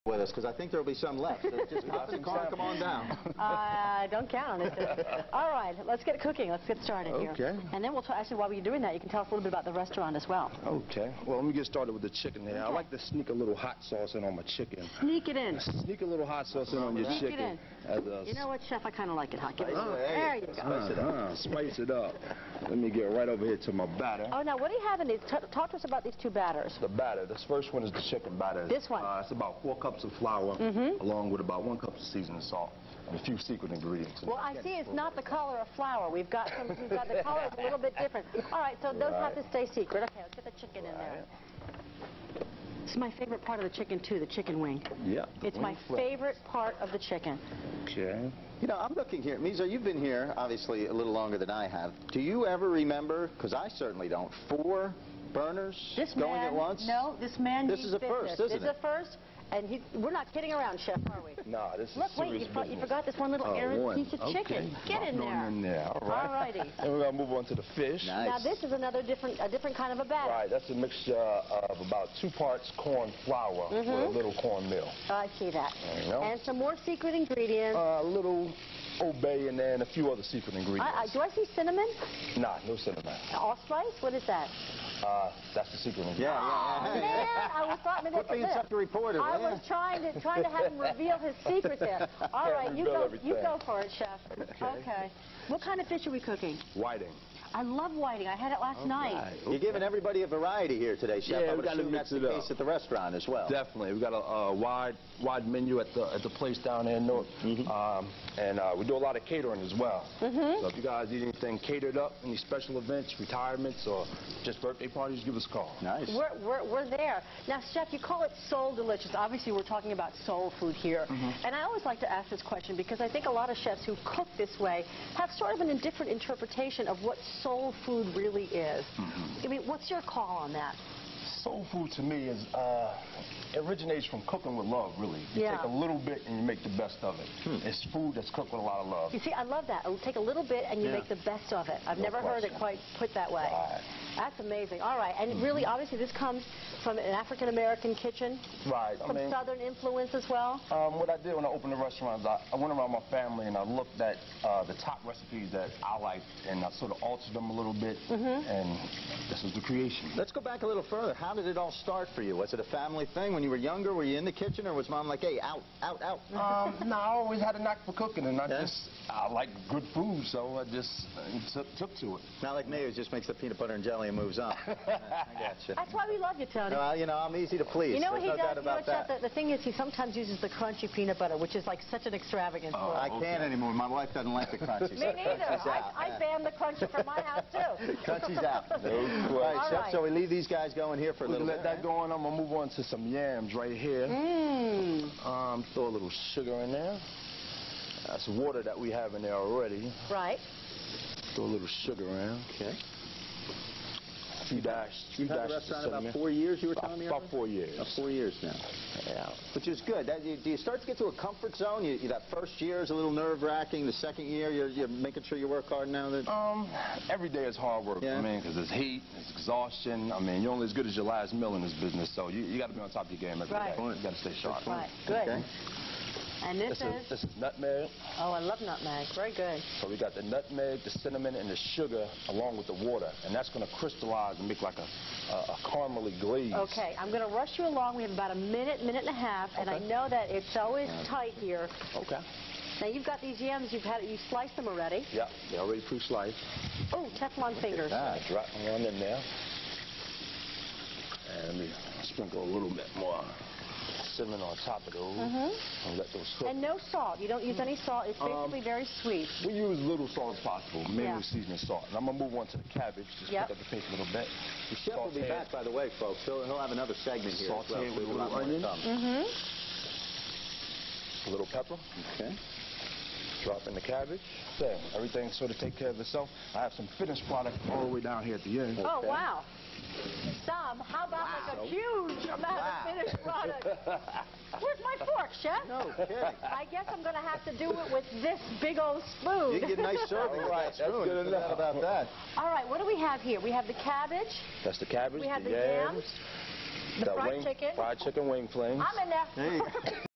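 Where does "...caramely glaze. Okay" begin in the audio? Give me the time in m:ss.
3:55.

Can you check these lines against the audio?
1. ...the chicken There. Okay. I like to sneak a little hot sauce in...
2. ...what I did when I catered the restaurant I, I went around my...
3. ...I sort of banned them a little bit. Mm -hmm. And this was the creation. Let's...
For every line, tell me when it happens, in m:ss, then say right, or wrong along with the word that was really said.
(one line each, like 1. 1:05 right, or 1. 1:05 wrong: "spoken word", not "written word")
1. 0:12 right
2. 2:30 wrong: "opened", not "catered"
3. 2:36 wrong: "altered", not "banned".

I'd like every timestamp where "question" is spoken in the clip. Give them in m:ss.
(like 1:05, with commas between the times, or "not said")
2:02, 2:22.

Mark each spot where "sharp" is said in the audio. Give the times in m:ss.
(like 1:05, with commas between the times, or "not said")
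3:44.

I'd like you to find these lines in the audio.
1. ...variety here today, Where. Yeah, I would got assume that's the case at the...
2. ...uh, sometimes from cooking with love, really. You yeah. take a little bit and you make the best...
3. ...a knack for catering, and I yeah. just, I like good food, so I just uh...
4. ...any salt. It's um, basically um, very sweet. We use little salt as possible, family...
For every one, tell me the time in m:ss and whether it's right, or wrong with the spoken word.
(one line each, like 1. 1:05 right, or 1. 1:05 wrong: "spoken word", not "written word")
1. 1:40 wrong: "Chef", not "Where"
2. 2:12 wrong: "originates", not "sometimes"
3. 2:47 wrong: "cooking", not "catering"
4. 4:17 wrong: "mainly", not "family".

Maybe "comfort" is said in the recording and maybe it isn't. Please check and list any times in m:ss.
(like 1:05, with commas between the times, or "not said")
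3:31.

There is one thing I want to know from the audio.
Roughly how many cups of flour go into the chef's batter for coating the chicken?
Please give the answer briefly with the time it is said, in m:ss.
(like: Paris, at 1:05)
4, at 0:29.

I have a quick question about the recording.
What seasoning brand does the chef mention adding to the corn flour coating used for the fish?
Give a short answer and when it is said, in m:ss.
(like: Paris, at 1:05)
Old Bay, at 1:19.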